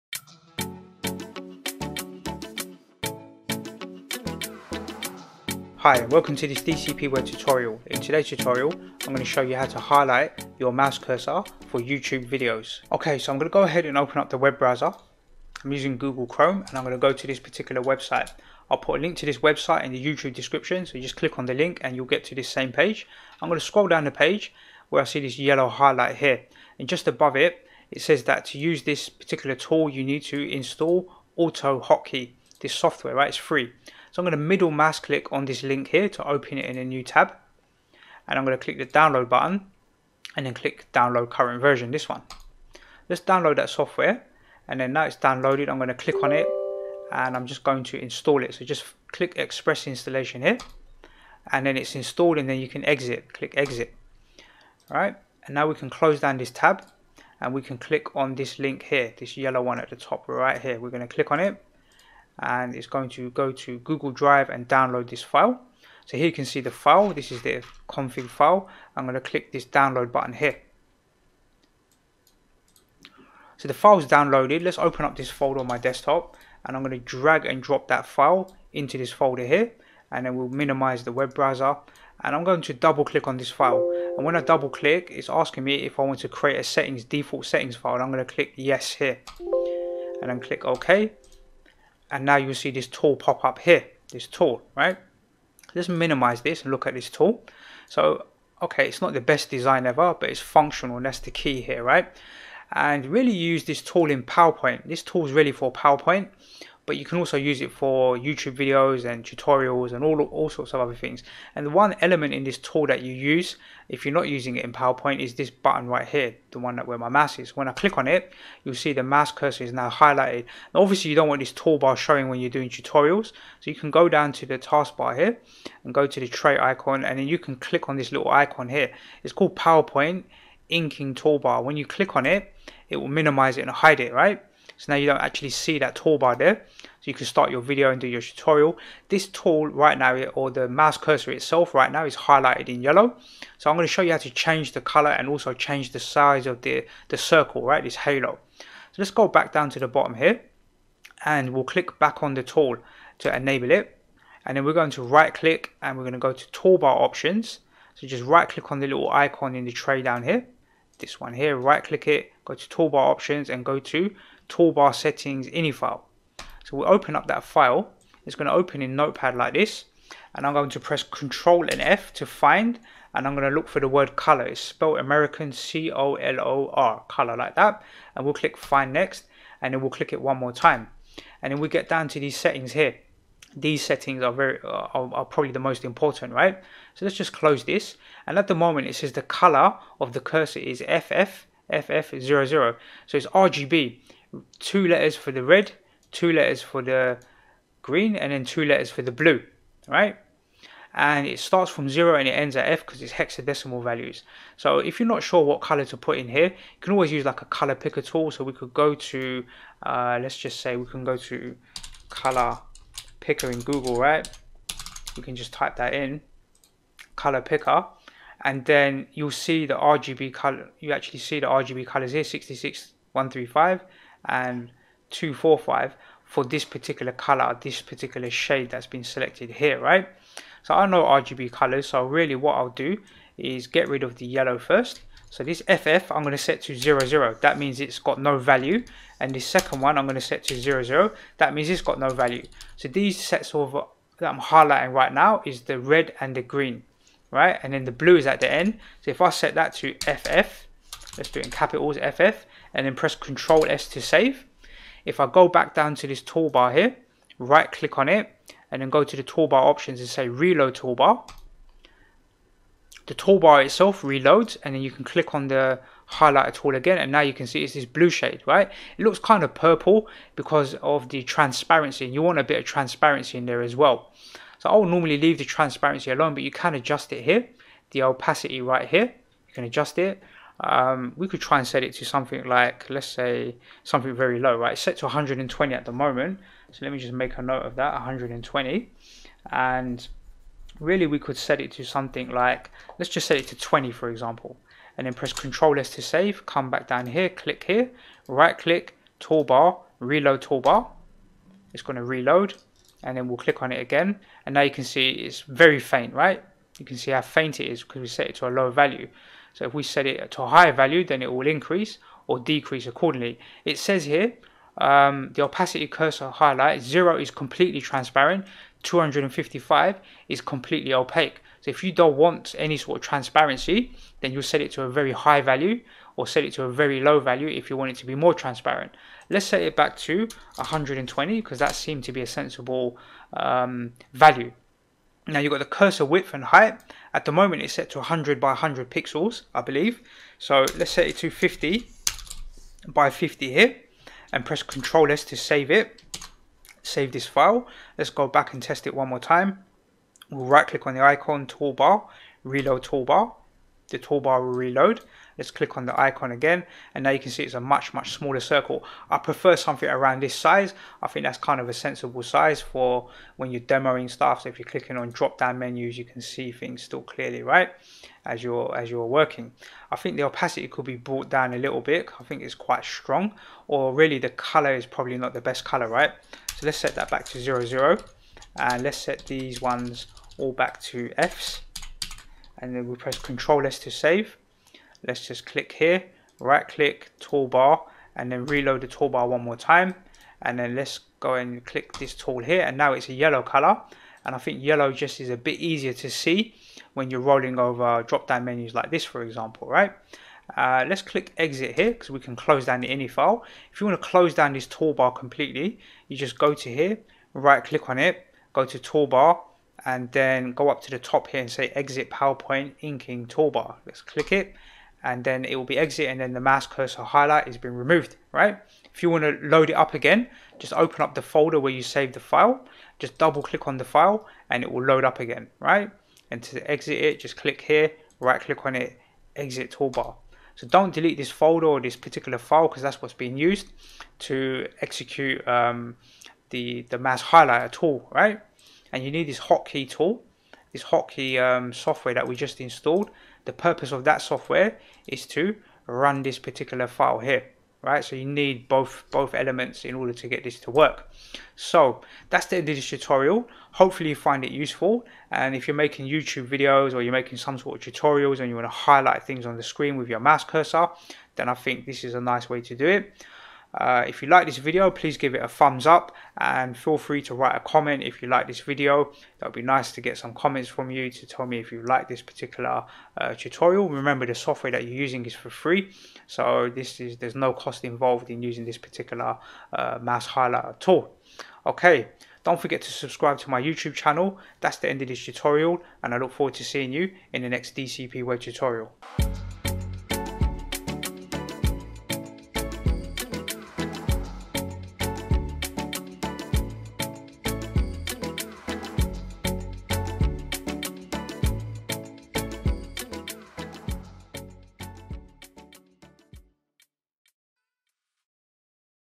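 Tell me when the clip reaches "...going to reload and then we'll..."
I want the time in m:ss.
5:01.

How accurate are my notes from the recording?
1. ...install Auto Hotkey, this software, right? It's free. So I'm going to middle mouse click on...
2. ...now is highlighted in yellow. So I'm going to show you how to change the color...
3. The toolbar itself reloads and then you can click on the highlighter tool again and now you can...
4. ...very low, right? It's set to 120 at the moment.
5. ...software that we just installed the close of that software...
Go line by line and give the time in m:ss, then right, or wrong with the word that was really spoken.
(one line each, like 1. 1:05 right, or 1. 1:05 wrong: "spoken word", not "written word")
1. 0:30 right
2. 2:21 right
3. 4:23 right
4. 4:44 right
5. 7:21 wrong: "purpose", not "close".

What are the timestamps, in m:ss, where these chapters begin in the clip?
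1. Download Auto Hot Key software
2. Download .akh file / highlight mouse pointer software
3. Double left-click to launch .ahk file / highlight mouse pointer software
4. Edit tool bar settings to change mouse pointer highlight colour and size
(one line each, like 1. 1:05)
1. 0:26
2. 0:58
3. 1:20
4. 2:26.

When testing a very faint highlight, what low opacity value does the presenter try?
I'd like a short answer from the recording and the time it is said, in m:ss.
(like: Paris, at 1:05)
20, at 4:53.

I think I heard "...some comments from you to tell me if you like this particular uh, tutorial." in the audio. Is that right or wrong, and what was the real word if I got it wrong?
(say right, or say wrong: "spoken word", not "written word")
right.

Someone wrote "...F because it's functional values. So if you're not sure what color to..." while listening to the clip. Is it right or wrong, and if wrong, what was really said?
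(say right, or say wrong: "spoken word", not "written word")
wrong: "hexadecimal", not "functional".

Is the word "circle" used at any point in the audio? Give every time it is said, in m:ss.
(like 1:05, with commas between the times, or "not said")
2:27, 5:58.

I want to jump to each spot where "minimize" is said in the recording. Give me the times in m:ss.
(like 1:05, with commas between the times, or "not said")
1:20, 1:35, 2:13.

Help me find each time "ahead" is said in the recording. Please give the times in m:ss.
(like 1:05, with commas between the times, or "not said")
0:13.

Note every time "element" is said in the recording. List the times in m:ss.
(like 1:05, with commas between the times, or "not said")
1:52, 7:29.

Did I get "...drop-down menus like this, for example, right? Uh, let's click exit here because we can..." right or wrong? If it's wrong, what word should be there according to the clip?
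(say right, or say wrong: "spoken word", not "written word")
right.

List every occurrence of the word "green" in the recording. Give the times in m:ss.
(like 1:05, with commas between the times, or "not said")
3:17, 4:06.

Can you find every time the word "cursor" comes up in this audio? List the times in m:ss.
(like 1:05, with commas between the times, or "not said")
0:10, 1:59, 2:20, 3:10, 5:15, 5:35, 6:56, 7:40.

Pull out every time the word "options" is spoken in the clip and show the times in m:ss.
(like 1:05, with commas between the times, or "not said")
2:37, 2:43, 4:19.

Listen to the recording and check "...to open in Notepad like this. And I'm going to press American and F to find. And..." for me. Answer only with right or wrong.
wrong.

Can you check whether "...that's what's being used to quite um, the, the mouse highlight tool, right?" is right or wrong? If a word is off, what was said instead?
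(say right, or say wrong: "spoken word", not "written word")
wrong: "execute", not "quite".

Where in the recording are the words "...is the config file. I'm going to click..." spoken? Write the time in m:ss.
1:07.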